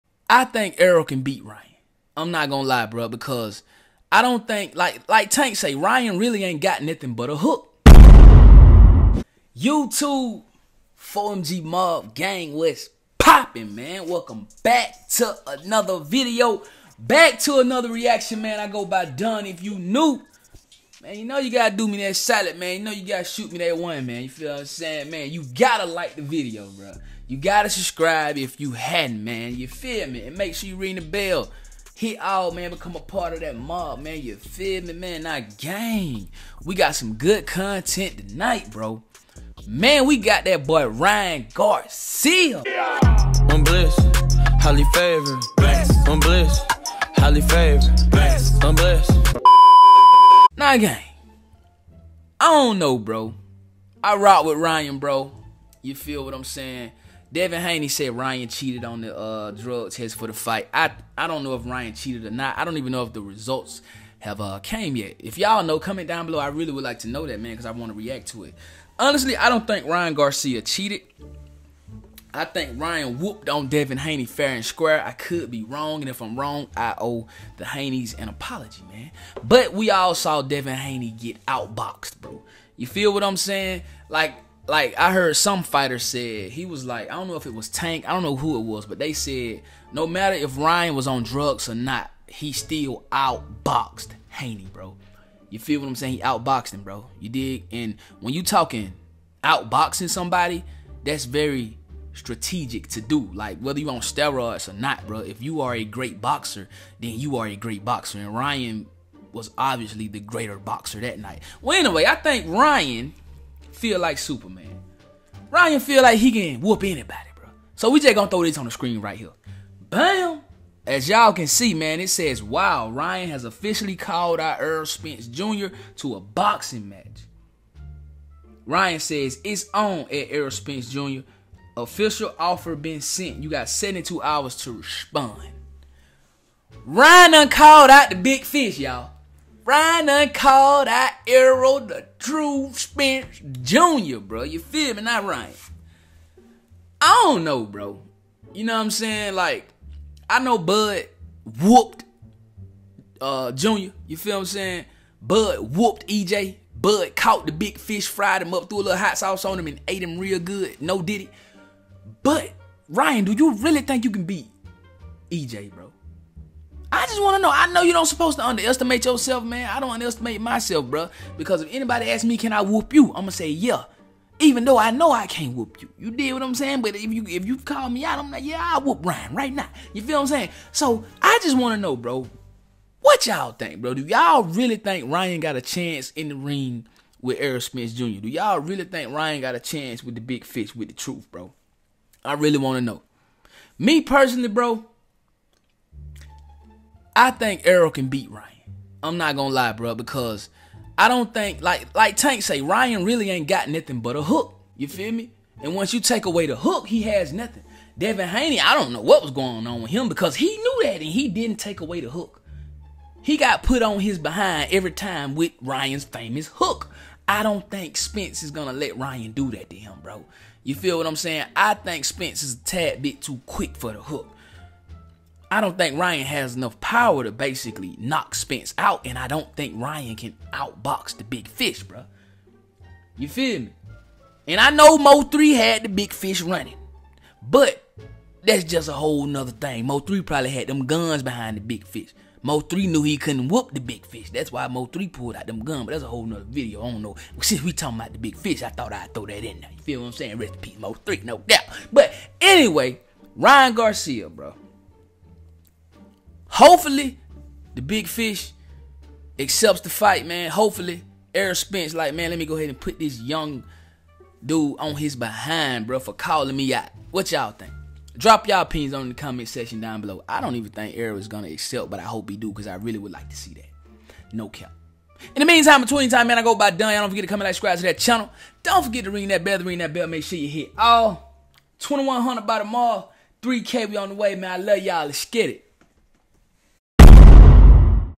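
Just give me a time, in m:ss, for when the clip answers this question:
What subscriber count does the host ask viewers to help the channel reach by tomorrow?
4:41.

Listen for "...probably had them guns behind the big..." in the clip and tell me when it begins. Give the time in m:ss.
4:00.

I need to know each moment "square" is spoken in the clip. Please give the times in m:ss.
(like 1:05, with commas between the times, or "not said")
1:14.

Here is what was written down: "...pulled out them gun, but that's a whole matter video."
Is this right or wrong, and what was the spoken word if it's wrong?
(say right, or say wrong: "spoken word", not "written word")
wrong: "nother", not "matter".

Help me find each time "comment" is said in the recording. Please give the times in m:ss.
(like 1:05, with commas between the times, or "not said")
1:05, 4:29, 4:37.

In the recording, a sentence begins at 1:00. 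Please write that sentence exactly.
I I don't know if Ryan cheated or not.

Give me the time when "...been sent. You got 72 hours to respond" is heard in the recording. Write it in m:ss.
2:12.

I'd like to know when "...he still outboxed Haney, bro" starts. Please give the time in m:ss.
1:32.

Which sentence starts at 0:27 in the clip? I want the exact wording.
You gotta subscribe if you hadn't, man.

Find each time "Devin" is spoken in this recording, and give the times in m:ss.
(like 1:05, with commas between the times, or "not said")
0:57, 1:13, 1:20, 3:27.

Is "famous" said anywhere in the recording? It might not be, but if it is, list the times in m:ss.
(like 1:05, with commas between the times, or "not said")
3:36.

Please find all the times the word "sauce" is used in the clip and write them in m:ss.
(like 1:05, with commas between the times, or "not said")
2:39.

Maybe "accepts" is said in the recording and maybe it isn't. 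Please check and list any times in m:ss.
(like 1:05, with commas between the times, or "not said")
4:19, 4:31.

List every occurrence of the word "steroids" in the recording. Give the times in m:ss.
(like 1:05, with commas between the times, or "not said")
1:44.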